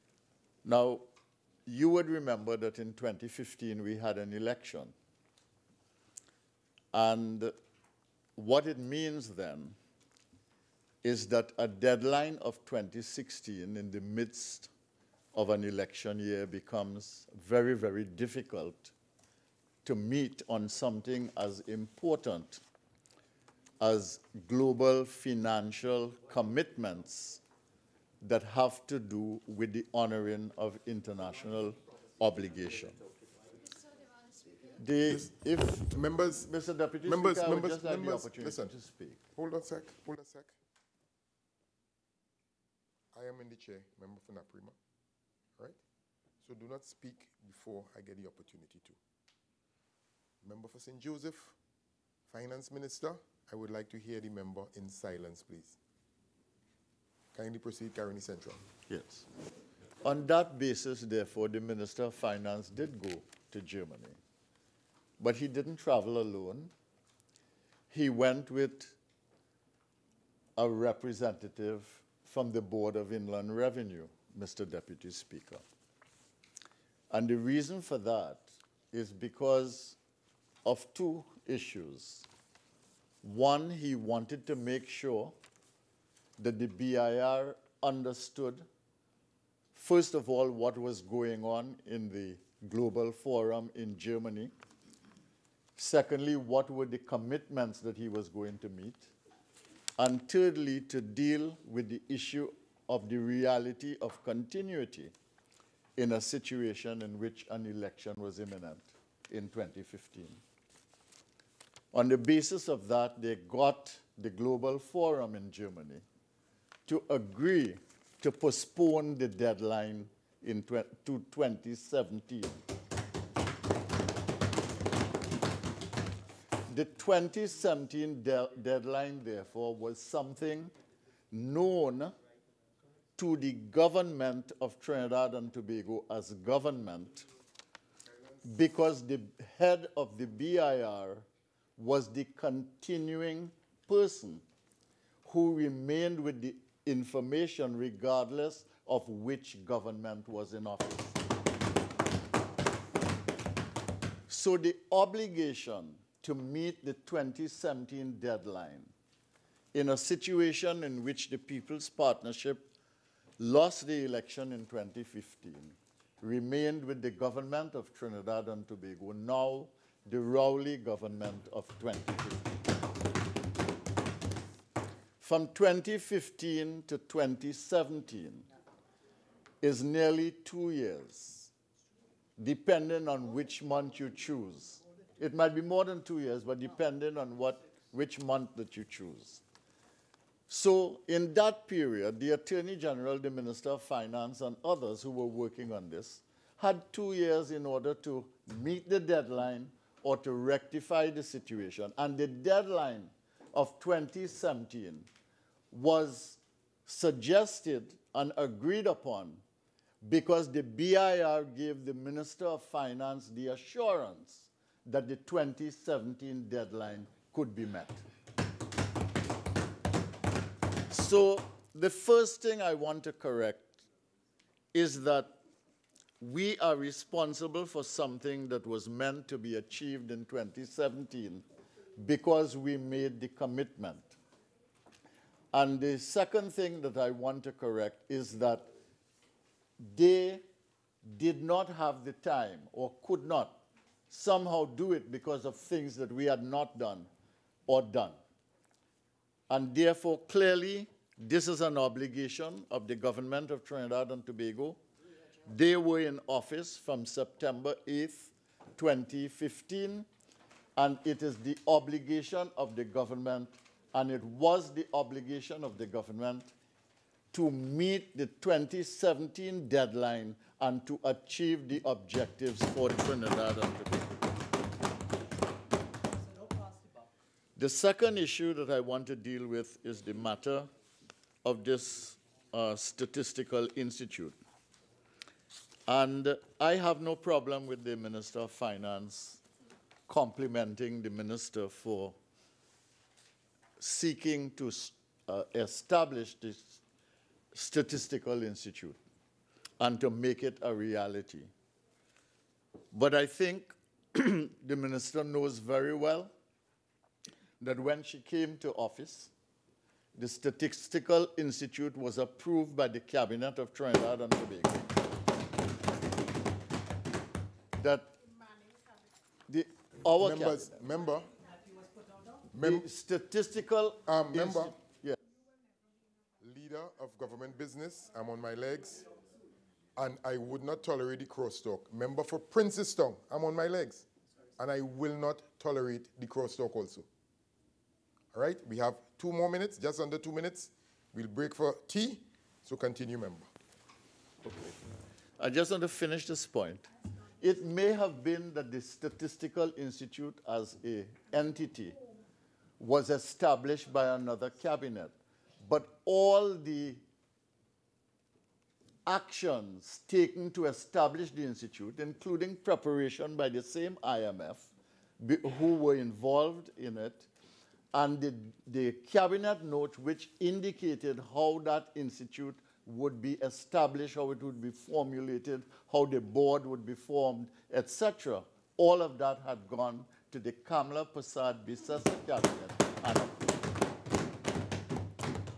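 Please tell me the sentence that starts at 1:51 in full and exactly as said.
On the basis of that, they got the Global Forum in Germany to agree to postpone the deadline in to 2017.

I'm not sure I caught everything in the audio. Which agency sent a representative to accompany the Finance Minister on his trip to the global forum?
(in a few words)
Board of Inland Revenue.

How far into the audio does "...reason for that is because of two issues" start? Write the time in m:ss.
1:17.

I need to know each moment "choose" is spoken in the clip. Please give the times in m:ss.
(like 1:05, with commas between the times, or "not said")
3:04, 3:08.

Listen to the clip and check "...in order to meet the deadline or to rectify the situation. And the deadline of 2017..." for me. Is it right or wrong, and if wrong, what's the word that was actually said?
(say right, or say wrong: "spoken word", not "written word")
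right.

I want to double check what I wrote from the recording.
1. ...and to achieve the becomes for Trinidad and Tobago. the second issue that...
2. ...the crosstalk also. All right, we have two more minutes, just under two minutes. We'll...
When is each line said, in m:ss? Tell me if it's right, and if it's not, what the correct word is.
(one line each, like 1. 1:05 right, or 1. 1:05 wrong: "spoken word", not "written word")
1. 4:30 wrong: "objectives", not "becomes"
2. 5:36 right.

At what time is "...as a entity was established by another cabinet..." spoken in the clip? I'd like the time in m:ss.
5:50.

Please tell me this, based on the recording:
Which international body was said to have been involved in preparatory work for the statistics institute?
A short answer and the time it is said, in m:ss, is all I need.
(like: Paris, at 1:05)
IMF, at 6:04.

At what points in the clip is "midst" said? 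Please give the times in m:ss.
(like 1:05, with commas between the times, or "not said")
0:14.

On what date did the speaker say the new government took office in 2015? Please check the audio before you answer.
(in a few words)
September 8th.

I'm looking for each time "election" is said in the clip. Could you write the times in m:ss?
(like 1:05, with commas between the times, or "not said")
0:04, 0:15, 1:47, 2:44.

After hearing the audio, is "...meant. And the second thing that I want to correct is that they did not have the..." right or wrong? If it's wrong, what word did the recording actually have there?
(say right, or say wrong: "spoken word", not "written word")
wrong: "commitment", not "meant".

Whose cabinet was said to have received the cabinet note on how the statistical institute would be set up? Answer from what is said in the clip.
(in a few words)
Kamla Persad-Bissessar.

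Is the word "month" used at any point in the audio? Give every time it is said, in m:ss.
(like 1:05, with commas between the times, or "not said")
3:03, 3:08.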